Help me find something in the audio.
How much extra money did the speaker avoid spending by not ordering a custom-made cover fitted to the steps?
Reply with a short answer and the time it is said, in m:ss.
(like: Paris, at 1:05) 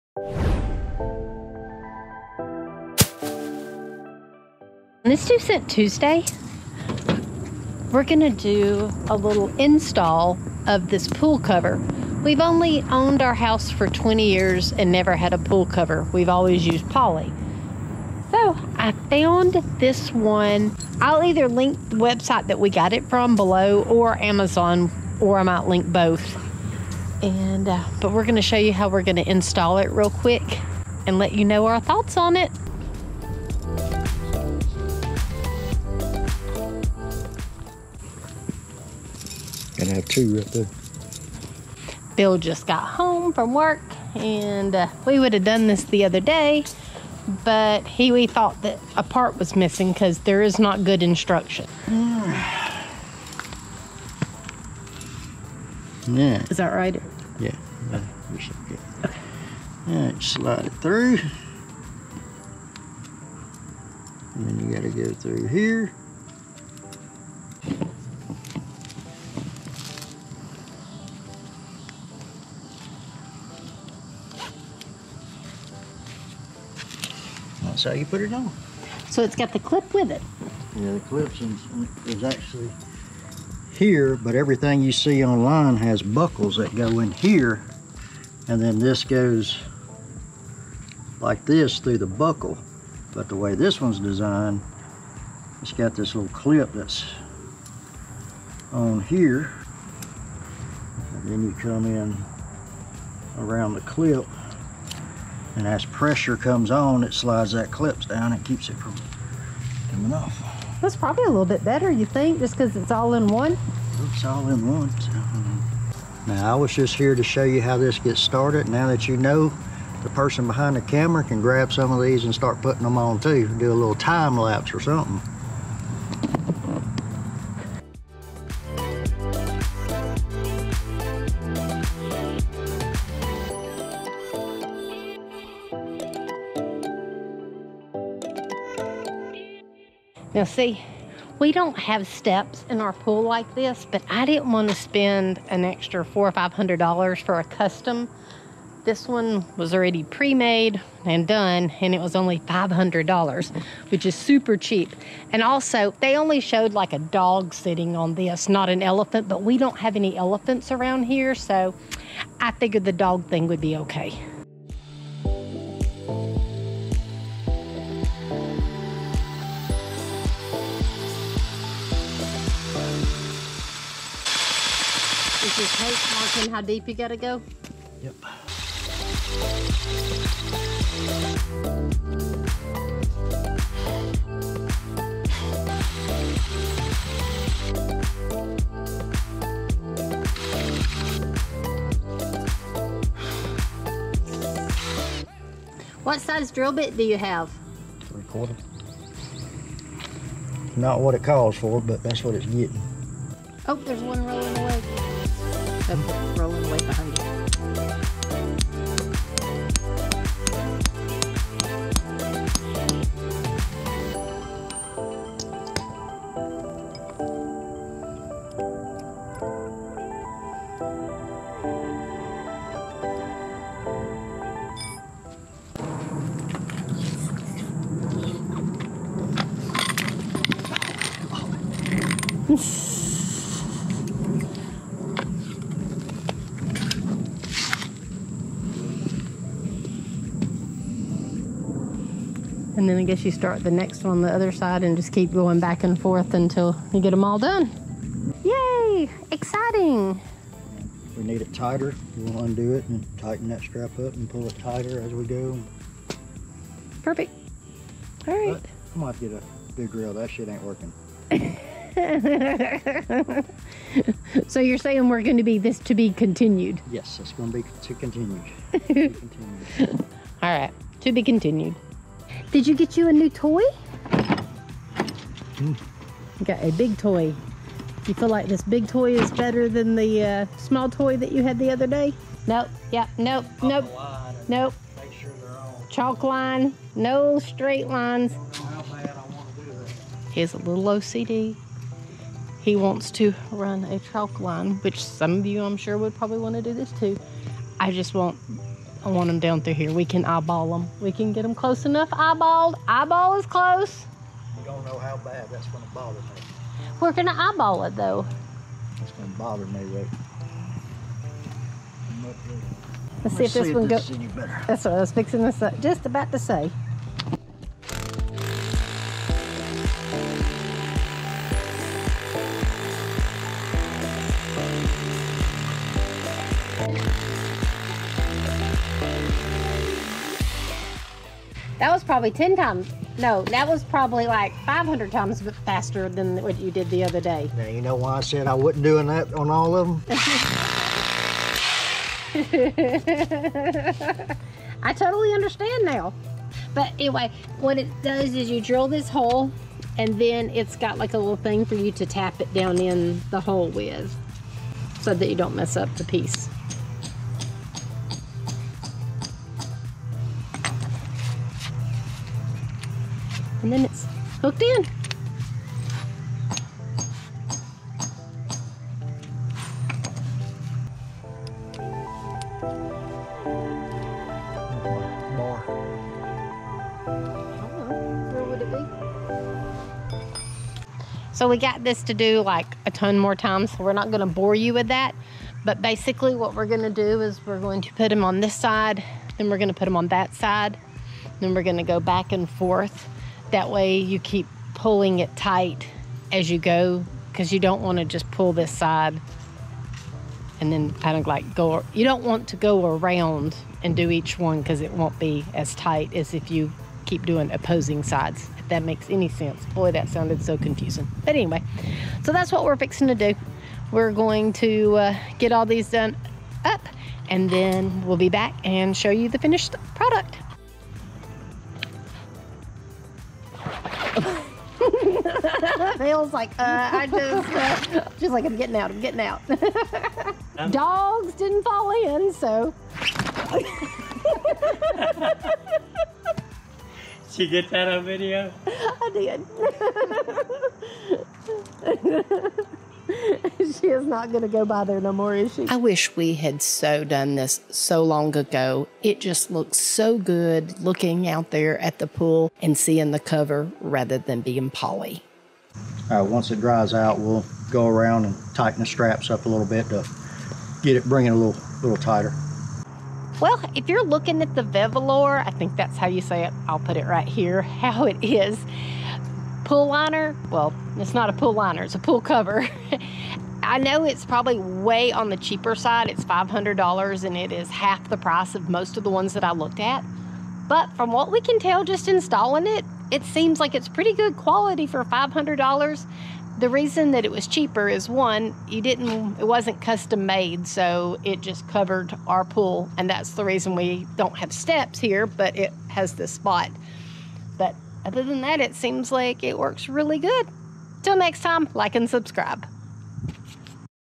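$400 to $500, at 2:26.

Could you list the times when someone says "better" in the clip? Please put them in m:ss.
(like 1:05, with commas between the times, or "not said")
1:51, 4:39.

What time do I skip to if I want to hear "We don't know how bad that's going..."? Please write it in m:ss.
5:04.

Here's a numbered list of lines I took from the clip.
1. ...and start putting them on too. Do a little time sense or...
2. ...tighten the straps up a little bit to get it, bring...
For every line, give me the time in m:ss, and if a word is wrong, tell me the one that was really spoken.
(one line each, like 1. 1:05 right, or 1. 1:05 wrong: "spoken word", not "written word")
1. 2:02 wrong: "lapse", not "sense"
2. 7:38 right.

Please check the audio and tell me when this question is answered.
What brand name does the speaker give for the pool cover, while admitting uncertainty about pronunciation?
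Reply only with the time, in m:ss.
7:44.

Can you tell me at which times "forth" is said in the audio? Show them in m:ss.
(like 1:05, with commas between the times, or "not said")
4:06, 6:32.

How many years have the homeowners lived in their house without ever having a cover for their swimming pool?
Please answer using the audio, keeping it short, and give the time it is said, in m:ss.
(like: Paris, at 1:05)
20, at 0:13.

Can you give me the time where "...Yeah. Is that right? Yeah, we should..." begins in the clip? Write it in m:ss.
0:56.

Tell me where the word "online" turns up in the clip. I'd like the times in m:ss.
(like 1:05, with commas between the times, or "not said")
1:25.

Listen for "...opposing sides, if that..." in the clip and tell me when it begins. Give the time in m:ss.
6:47.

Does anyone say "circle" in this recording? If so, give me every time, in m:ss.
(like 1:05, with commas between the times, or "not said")
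not said.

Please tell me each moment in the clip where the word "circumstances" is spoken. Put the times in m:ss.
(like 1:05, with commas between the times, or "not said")
not said.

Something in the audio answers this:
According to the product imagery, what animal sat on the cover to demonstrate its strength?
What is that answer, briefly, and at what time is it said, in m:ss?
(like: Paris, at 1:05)
A dog, at 2:36.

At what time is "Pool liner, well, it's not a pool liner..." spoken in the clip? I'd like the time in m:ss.
7:49.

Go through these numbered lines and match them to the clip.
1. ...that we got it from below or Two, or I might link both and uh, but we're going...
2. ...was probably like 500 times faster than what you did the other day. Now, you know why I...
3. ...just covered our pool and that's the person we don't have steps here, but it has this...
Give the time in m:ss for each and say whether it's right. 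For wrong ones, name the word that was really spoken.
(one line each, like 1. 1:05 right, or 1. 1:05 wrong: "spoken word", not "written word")
1. 0:22 wrong: "Amazon", not "Two"
2. 5:33 right
3. 8:11 wrong: "reason", not "person".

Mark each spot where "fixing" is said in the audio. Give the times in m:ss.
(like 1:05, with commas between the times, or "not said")
5:15, 6:52.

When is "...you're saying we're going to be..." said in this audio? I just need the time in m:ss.
4:24.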